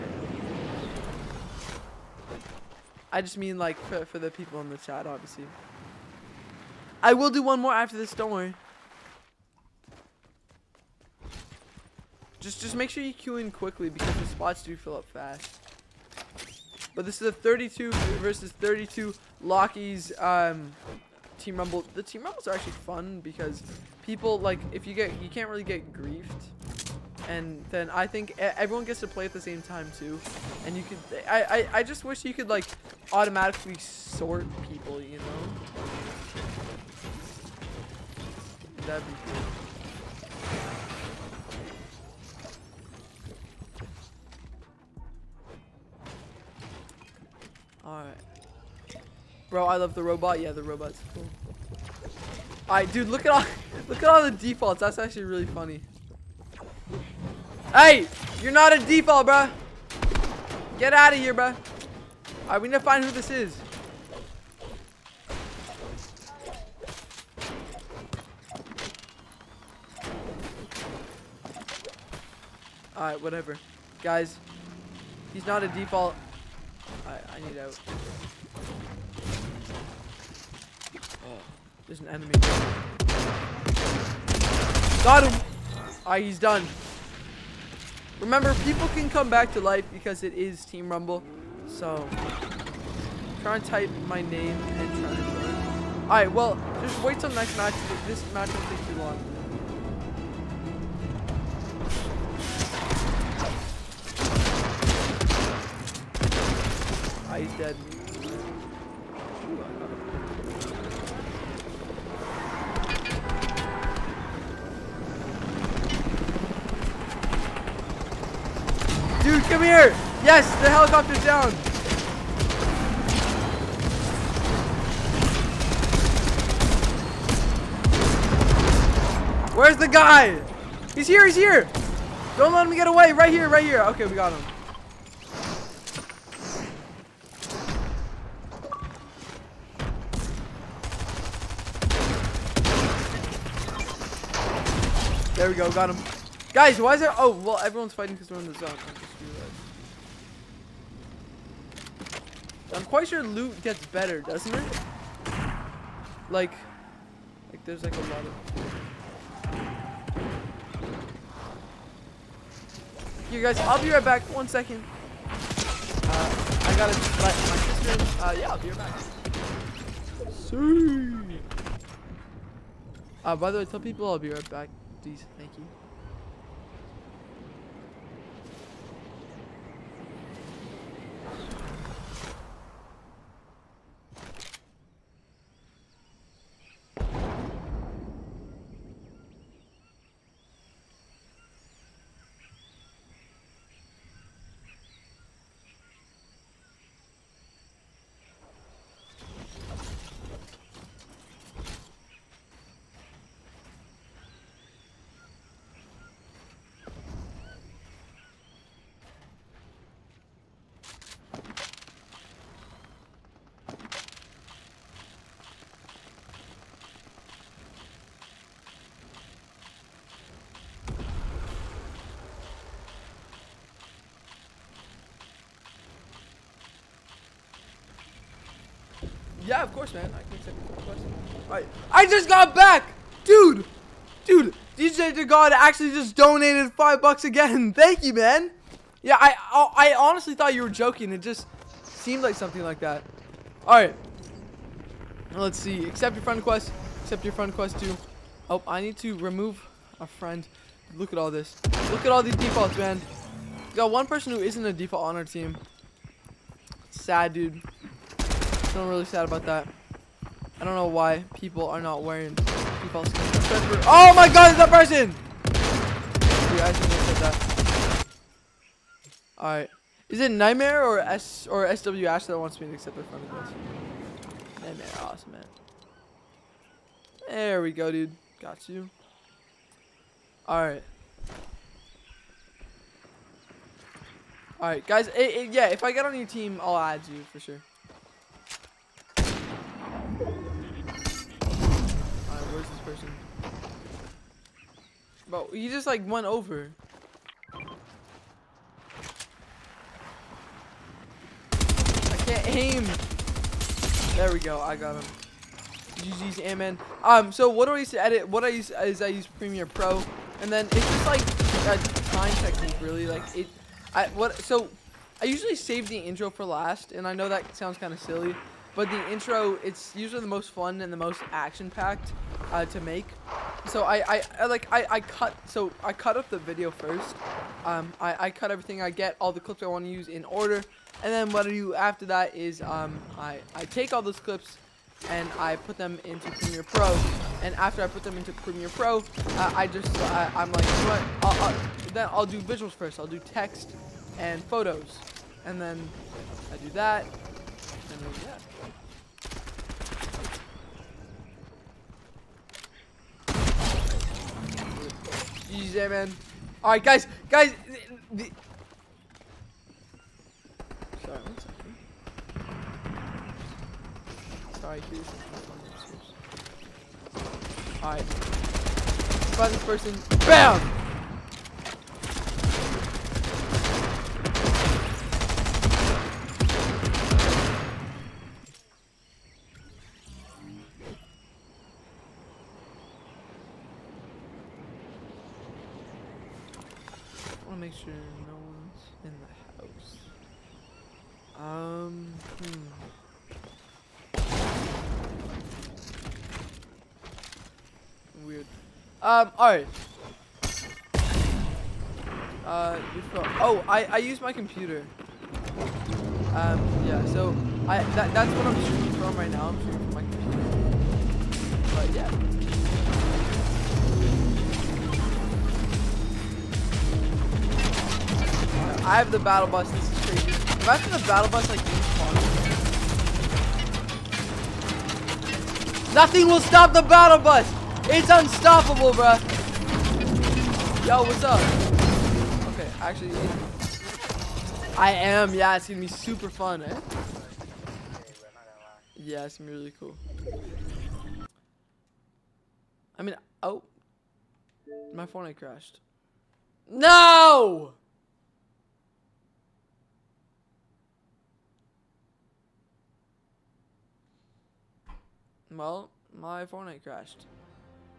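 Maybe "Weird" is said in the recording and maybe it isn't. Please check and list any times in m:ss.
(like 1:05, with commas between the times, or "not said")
6:38.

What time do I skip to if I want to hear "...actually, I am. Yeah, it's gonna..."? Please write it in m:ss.
7:12.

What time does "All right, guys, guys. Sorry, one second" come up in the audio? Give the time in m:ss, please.
5:56.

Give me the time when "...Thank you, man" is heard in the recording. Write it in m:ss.
3:57.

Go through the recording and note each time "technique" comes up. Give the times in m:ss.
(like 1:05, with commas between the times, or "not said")
5:12.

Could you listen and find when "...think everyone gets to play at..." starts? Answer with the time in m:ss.
0:28.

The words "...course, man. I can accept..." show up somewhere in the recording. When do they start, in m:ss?
3:49.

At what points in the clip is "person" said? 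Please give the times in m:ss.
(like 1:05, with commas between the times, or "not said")
4:14, 4:24, 6:09.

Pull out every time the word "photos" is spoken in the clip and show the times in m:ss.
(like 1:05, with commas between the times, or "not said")
5:44.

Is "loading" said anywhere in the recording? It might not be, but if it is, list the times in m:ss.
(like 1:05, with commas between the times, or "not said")
not said.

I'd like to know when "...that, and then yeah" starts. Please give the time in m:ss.
5:46.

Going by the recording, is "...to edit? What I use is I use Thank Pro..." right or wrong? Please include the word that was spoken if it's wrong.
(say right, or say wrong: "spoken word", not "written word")
wrong: "Premiere", not "Thank".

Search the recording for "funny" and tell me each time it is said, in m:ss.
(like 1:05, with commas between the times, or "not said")
0:55.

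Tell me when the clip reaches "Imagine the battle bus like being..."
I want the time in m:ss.
7:00.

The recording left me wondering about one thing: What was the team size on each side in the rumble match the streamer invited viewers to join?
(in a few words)
32.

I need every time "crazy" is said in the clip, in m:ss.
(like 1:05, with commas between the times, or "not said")
7:00.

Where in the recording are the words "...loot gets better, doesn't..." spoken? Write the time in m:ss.
2:33.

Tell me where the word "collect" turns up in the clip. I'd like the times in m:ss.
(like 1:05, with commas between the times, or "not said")
not said.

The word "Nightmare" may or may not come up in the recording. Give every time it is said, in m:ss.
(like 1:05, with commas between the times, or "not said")
4:30, 4:34.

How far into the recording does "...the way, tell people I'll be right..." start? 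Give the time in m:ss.
2:53.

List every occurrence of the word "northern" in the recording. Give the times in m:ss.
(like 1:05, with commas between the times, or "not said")
not said.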